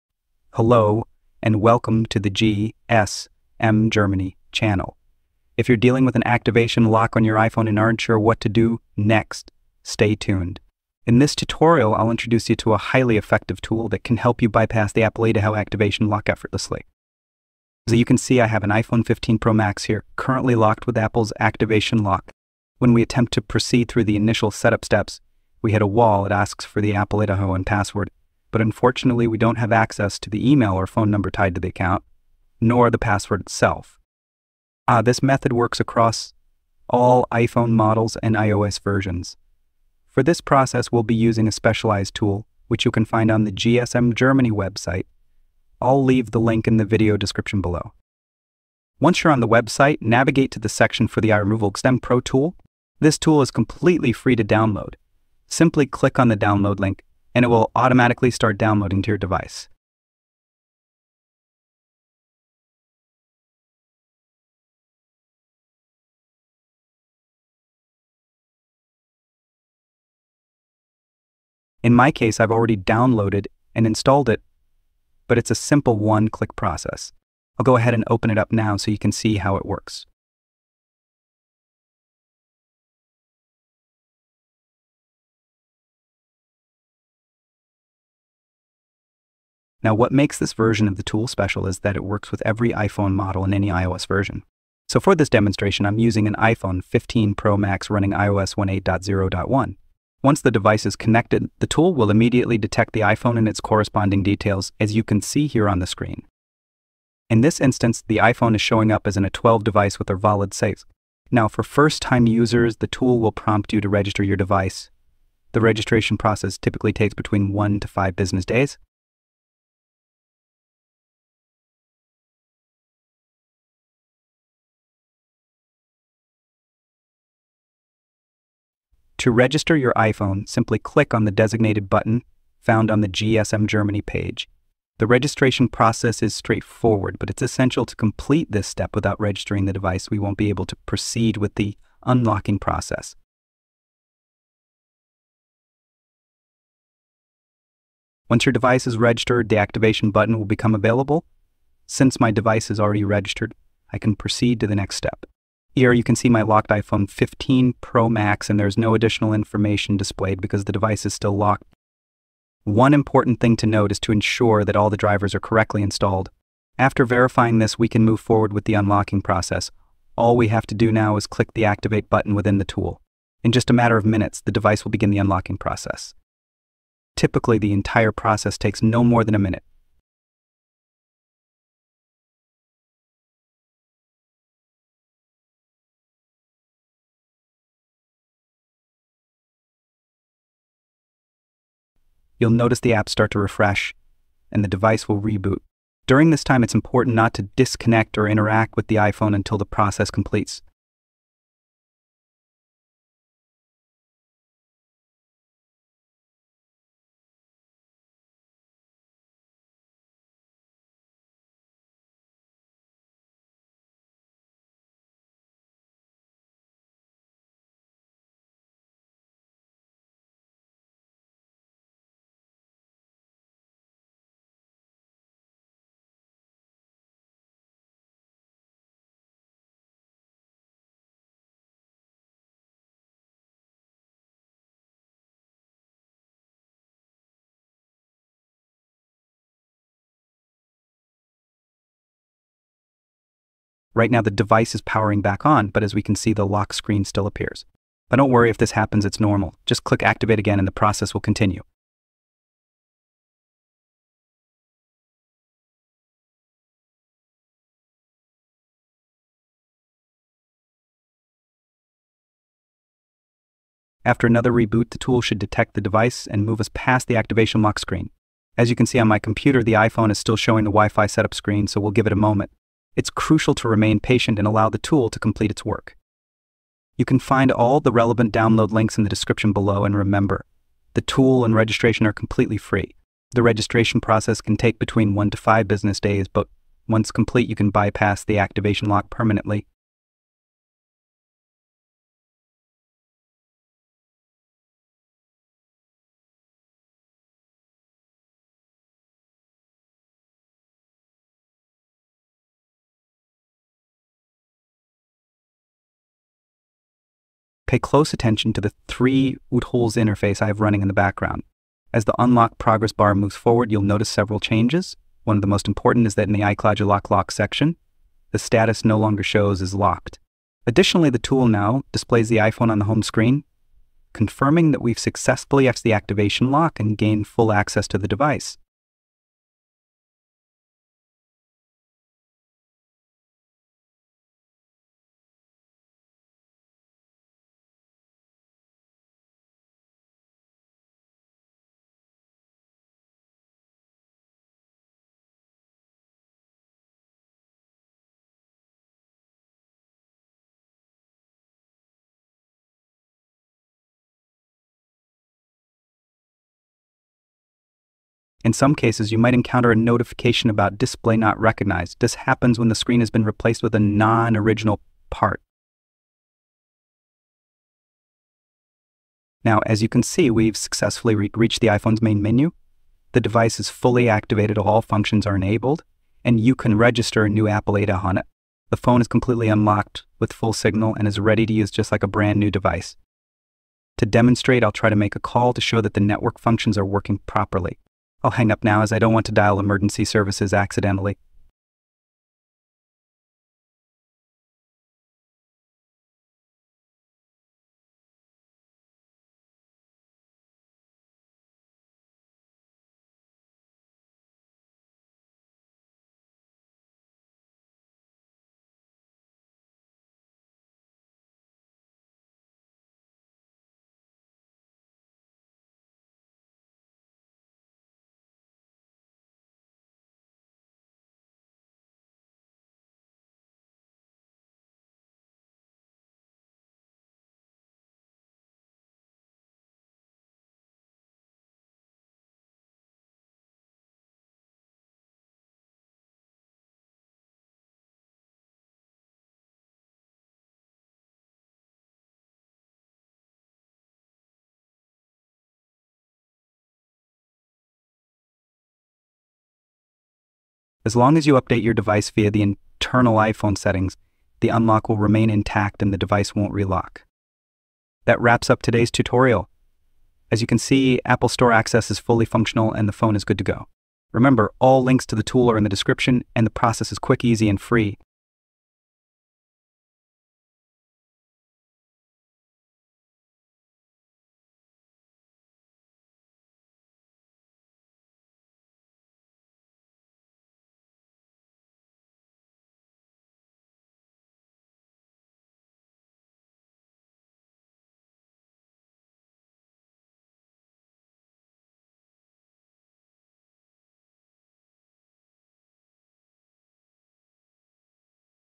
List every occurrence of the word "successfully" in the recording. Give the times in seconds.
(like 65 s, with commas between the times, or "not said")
324 s, 370 s.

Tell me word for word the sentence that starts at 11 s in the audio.
In this tutorial, I'll introduce you to a highly effective tool that can help you bypass the Apple AdaHow activation lock effortlessly.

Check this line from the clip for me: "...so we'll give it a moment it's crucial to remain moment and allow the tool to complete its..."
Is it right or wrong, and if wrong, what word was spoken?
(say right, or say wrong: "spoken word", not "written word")
wrong: "patient", not "moment".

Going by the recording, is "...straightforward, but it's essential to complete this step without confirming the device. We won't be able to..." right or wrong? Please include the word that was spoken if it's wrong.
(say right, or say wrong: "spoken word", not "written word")
wrong: "registering", not "confirming".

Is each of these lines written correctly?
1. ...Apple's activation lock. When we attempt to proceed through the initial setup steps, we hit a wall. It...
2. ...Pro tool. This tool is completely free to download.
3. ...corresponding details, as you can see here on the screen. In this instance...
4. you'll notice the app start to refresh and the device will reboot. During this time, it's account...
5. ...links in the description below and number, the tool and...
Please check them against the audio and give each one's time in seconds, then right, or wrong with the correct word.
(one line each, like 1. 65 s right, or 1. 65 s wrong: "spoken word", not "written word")
1. 20 s right
2. 52 s right
3. 103 s right
4. 192 s wrong: "important", not "account"
5. 278 s wrong: "remember", not "number".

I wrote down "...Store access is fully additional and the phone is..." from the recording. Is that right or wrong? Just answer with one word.
wrong.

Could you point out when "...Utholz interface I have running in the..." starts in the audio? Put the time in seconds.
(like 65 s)
309 s.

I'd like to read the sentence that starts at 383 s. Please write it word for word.
To demonstrate, I'll try to make a call to show that the network functions are working properly.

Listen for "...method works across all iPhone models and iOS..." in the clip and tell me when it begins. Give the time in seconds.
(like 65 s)
35 s.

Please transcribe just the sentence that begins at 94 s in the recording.
So for this demonstration, I'm using an iPhone 15 Pro Max running iOS 18.0.1.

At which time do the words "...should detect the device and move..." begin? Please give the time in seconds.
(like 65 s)
265 s.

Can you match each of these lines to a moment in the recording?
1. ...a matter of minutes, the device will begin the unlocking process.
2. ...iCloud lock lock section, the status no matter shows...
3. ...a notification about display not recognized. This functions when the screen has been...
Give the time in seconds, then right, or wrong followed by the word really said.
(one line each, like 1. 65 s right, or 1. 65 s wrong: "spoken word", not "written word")
1. 173 s right
2. 316 s wrong: "longer", not "matter"
3. 359 s wrong: "happens", not "functions".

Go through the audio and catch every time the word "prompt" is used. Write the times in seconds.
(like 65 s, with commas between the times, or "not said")
113 s.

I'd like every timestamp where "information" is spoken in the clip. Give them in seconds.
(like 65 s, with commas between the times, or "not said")
159 s.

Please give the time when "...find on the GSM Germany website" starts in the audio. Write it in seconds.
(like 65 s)
43 s.